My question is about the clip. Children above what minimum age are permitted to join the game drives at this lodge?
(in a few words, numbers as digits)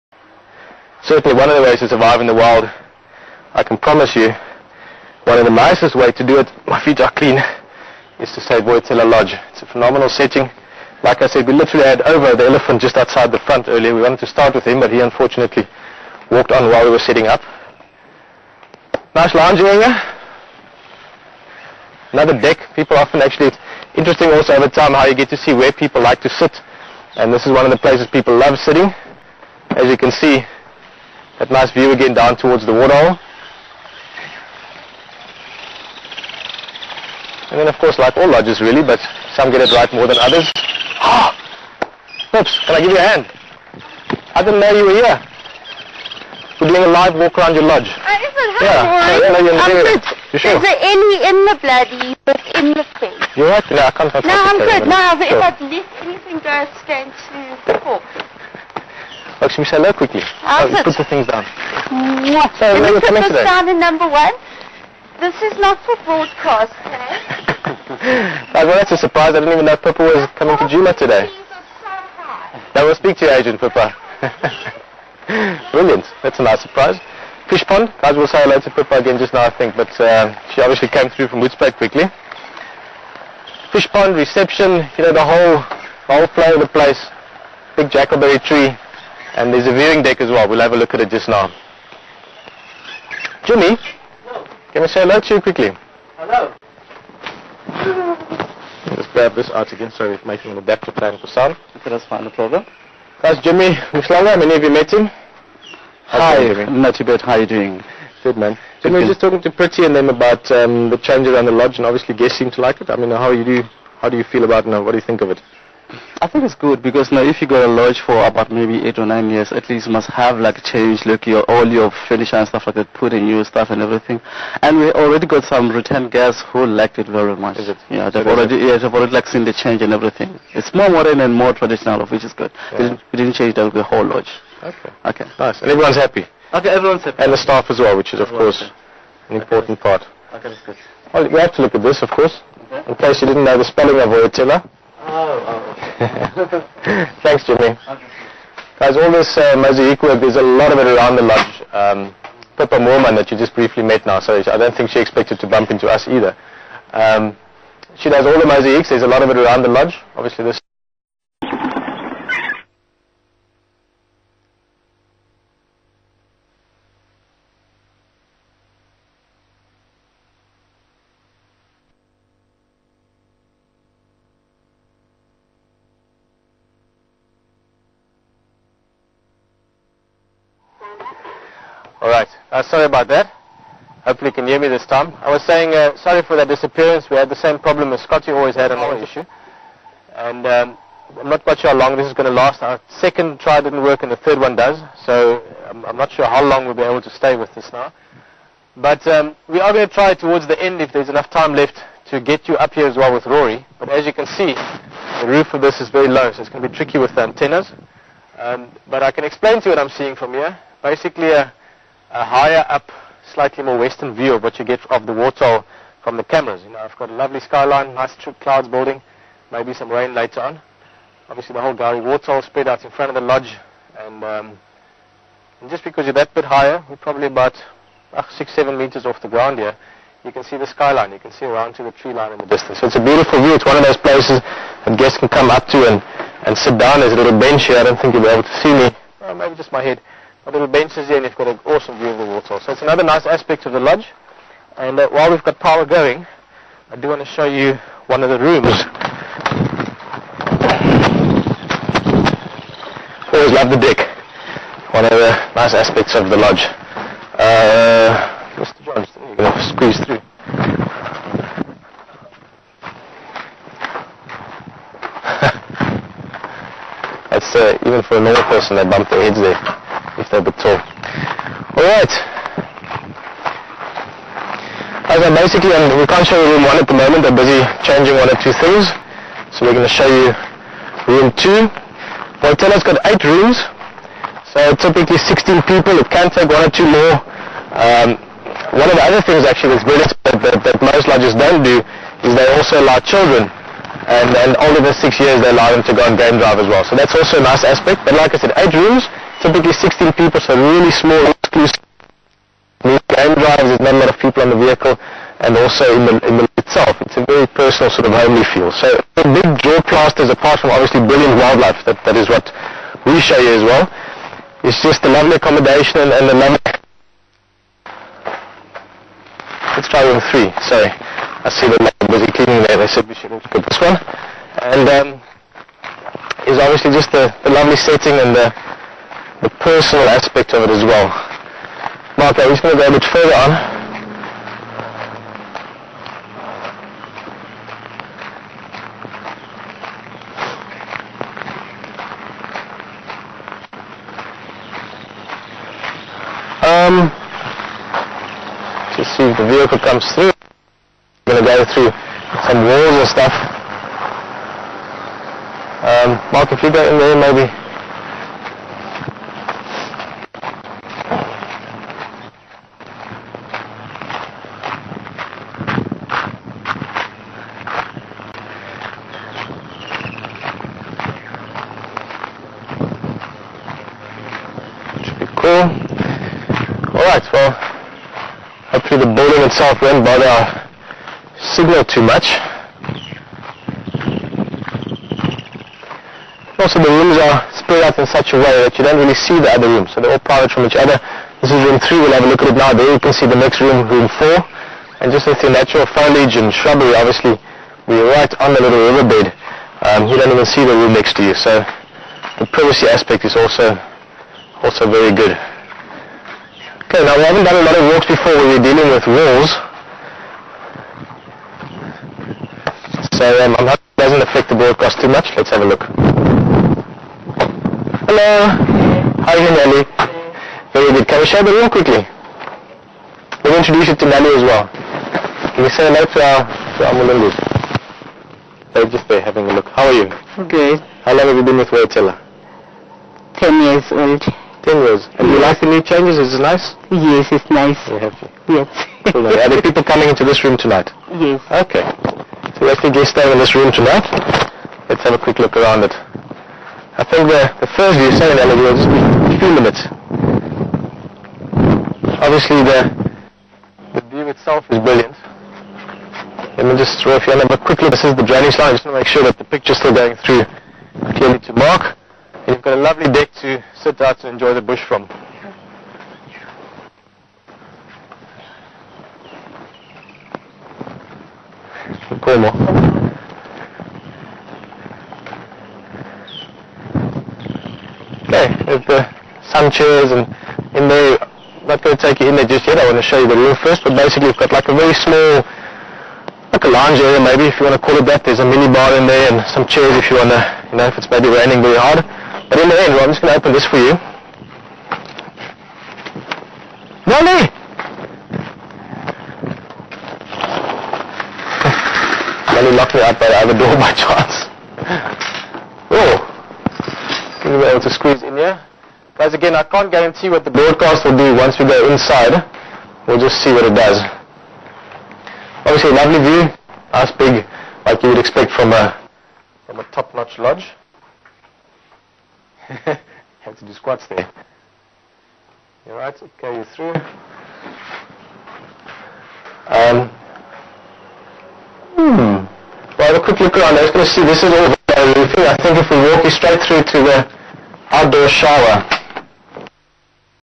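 6.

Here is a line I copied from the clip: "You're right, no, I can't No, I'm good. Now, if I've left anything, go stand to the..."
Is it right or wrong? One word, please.
right.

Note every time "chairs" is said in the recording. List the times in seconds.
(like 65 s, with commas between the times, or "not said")
479 s, 489 s.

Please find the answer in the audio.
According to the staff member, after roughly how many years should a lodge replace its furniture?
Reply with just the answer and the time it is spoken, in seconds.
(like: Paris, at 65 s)
8 or 9 years, at 118 s.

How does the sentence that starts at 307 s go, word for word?
It's a very personal sort of homely feel.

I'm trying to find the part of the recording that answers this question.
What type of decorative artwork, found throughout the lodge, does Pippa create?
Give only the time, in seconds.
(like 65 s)
149 s.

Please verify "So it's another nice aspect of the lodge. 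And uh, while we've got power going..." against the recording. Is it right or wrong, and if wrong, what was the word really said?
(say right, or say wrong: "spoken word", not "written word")
right.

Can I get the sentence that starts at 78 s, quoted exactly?
Guys, we'll say hello to Pippa again just now, I think.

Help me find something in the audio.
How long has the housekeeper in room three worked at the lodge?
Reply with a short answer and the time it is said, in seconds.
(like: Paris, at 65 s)
10 years, at 434 s.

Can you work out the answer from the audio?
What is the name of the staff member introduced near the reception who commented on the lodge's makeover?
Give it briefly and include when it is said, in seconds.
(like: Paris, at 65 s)
Jimmy Mushlanga, at 103 s.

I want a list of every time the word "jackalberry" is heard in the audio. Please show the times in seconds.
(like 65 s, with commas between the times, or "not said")
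87 s.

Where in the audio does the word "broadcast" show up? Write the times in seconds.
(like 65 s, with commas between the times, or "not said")
66 s, 414 s, 510 s.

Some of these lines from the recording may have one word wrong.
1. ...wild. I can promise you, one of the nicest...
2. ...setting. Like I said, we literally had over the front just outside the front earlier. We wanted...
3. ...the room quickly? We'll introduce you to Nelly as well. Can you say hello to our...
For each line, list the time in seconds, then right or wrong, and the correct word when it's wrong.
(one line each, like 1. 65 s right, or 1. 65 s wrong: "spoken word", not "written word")
1. 2 s right
2. 10 s wrong: "elephant", not "front"
3. 421 s right.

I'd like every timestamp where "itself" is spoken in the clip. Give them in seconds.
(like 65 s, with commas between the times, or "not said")
306 s, 379 s, 454 s.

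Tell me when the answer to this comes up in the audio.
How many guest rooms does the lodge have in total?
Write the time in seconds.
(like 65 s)
283 s.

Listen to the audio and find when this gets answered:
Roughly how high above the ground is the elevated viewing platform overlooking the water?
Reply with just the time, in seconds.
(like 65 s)
228 s.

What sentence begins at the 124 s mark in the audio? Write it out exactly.
And we already got some return guests who liked it very much.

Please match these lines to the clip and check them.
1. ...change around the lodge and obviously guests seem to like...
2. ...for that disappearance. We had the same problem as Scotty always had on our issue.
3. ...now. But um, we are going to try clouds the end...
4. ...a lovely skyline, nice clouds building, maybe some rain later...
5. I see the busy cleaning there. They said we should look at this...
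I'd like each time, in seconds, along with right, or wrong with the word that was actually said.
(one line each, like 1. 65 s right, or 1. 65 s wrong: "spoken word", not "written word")
1. 110 s right
2. 186 s right
3. 197 s wrong: "towards", not "clouds"
4. 217 s right
5. 320 s right.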